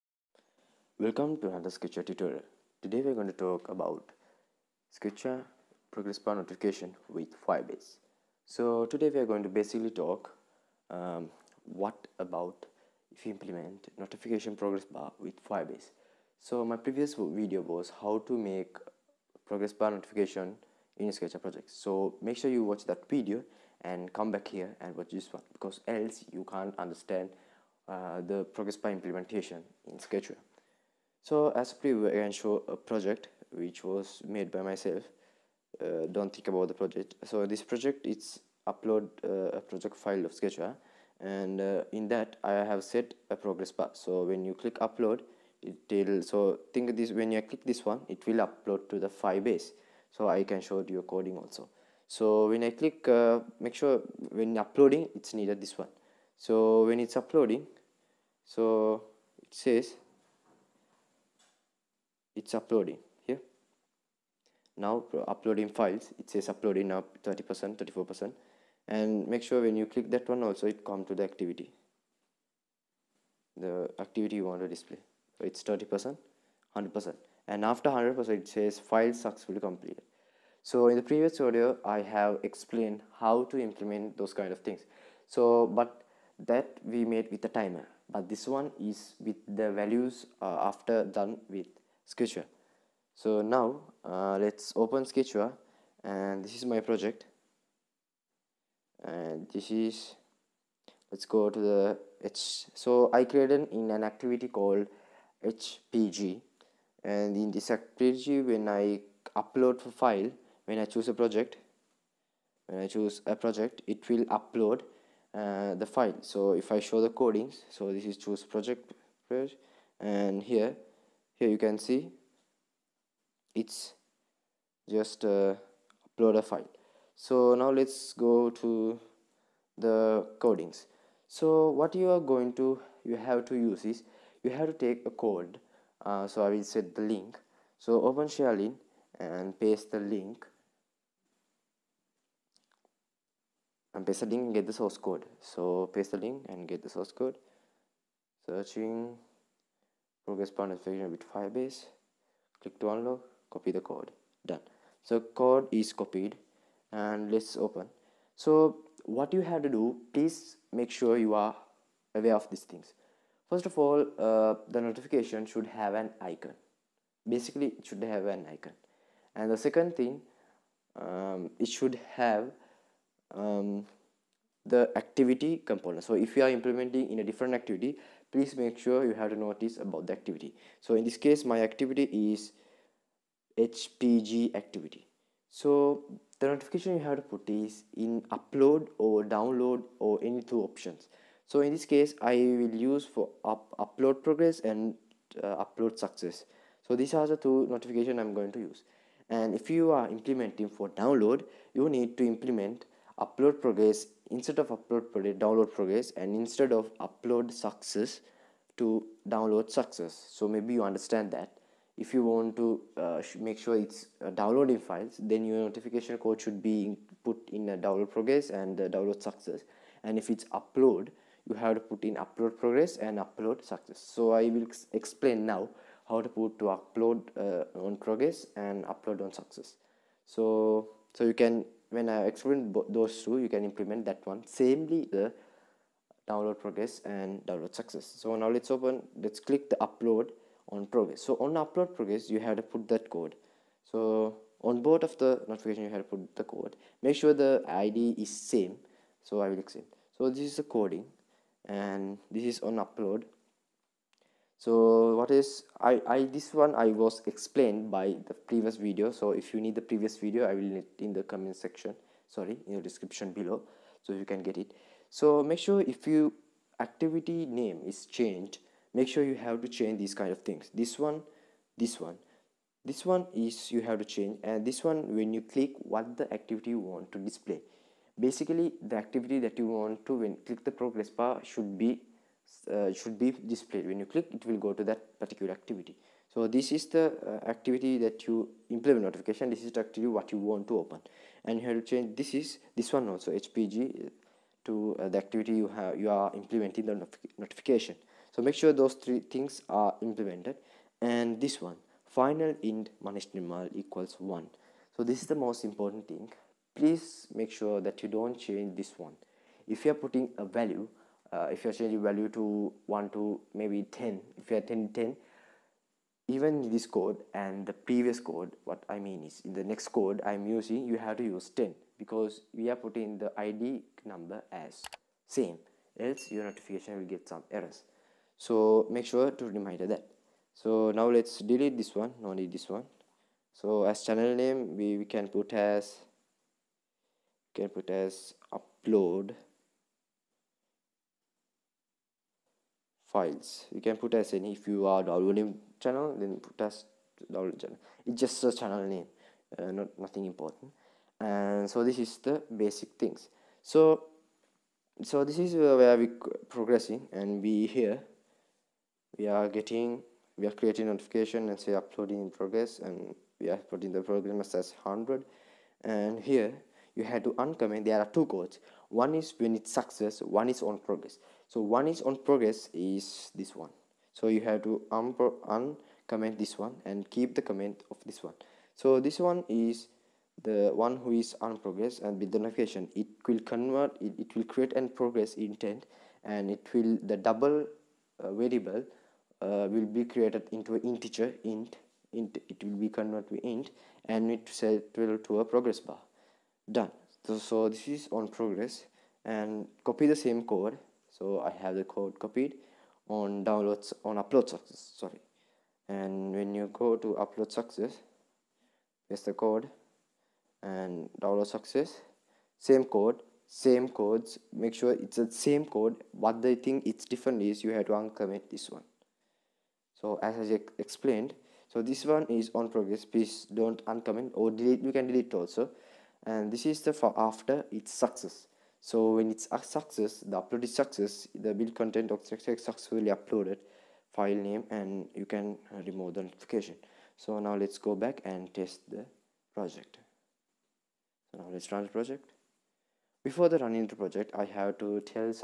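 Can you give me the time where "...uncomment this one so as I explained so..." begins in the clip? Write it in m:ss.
6:57.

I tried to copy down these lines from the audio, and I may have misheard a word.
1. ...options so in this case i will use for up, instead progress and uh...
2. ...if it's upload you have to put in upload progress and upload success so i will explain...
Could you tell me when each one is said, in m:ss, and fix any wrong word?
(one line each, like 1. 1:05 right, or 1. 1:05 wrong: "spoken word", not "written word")
1. 3:10 wrong: "upload", not "instead"
2. 3:40 right.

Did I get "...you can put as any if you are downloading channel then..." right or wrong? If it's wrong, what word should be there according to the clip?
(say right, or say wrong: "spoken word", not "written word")
right.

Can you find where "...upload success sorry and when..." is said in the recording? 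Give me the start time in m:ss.
6:44.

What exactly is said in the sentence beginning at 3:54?
Samely, the download progress and download success.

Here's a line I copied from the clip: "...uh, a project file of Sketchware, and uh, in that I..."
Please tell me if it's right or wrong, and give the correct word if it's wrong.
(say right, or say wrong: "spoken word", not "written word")
right.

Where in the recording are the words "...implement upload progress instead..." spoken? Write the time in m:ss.
3:22.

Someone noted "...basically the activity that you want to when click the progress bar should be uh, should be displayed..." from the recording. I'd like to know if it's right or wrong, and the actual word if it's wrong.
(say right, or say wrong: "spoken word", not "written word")
right.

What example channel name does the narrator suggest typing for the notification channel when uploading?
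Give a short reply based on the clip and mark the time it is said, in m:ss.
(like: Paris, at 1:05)
upload files, at 5:38.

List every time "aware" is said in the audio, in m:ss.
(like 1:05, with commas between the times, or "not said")
2:42.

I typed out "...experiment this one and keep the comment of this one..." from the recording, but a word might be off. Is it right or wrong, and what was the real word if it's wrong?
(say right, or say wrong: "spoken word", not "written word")
wrong: "comment", not "experiment".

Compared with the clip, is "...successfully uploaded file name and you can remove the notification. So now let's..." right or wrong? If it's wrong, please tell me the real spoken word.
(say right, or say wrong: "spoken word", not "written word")
right.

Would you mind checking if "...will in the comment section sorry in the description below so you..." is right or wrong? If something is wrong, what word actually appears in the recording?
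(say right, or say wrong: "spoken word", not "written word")
right.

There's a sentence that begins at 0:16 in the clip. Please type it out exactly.
So my previous video was how to make progress bar notification in Sketchware project.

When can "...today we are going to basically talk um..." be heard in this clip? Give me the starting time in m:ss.
0:08.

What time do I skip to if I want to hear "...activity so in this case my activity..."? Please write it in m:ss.
3:00.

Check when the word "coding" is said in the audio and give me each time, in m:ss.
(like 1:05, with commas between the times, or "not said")
0:51, 1:57, 2:10, 4:10.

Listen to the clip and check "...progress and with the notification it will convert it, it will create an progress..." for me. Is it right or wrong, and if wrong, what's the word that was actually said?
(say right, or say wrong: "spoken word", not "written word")
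right.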